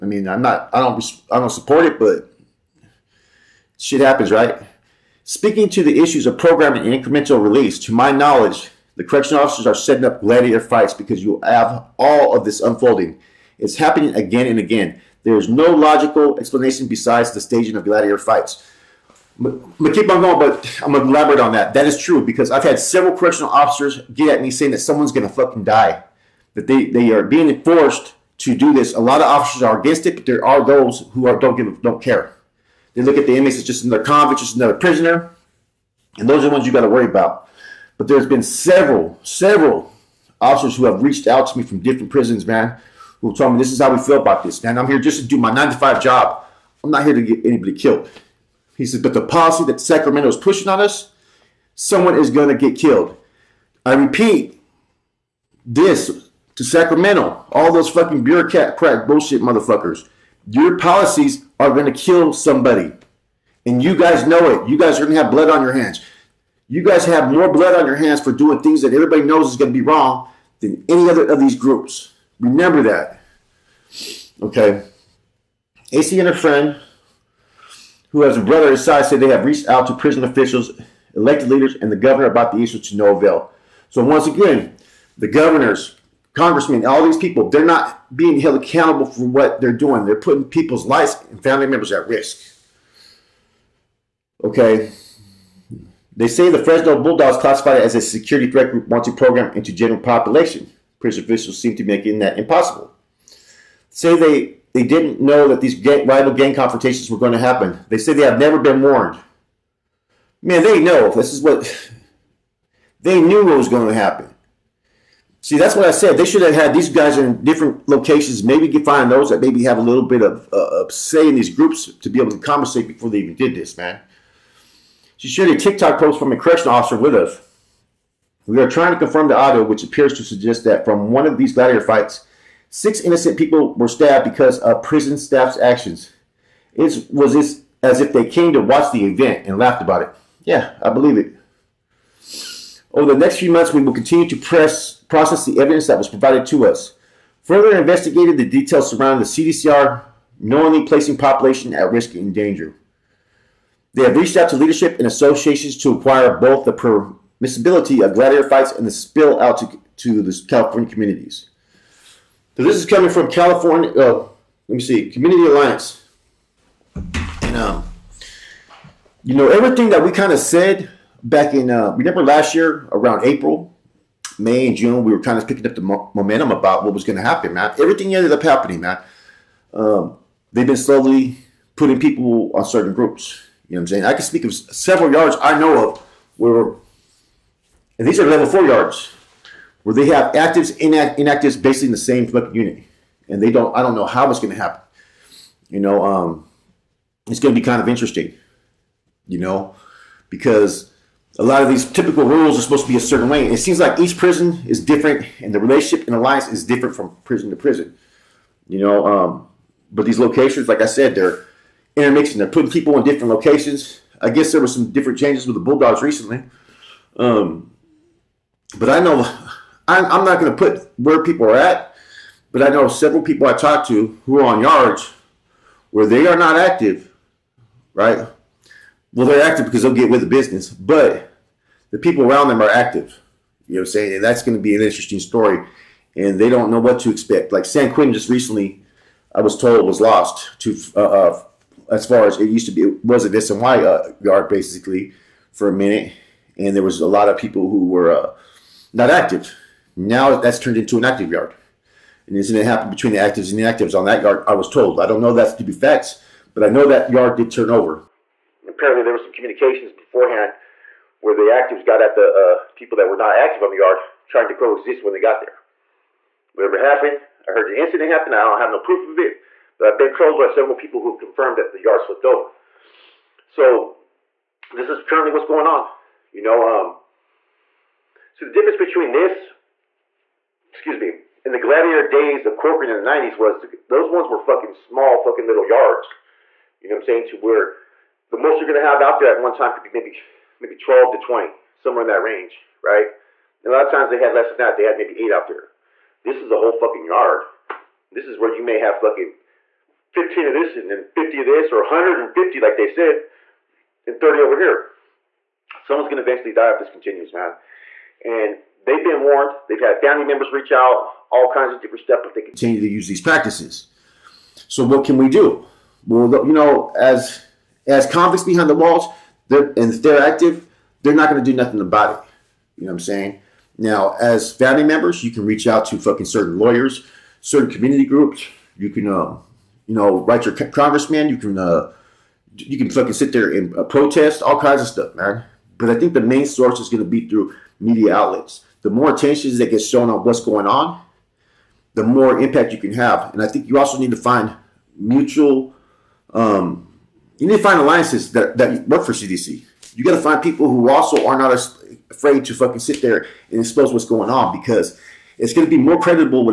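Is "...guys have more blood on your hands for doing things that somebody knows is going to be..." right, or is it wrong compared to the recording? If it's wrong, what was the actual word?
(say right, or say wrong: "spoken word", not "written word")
wrong: "everybody", not "somebody".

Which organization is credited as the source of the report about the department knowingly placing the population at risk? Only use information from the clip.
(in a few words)
Community Alliance.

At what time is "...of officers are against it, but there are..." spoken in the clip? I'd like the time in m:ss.
0:29.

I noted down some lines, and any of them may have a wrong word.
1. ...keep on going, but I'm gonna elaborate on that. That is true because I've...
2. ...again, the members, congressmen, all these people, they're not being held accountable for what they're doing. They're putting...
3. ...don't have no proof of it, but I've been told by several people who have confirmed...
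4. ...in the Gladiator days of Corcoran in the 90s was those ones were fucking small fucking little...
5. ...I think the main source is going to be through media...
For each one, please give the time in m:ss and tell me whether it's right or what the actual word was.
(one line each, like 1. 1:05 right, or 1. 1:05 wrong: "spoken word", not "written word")
1. 0:19 right
2. 1:24 wrong: "governors", not "members"
3. 4:28 right
4. 4:41 right
5. 5:35 right.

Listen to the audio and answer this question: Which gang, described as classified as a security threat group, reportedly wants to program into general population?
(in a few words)
Fresno Bulldogs.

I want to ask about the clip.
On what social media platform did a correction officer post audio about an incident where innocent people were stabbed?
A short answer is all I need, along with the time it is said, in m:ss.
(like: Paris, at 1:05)
TikTok, at 2:05.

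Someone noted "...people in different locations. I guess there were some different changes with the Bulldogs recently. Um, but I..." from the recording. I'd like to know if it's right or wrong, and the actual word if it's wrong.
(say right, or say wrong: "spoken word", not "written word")
right.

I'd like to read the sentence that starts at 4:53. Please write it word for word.
And a lot of times they had less than that.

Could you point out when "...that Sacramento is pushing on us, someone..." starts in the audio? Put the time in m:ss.
0:49.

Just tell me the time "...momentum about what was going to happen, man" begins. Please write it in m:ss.
2:56.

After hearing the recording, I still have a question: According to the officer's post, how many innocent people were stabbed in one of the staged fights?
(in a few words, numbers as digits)
6.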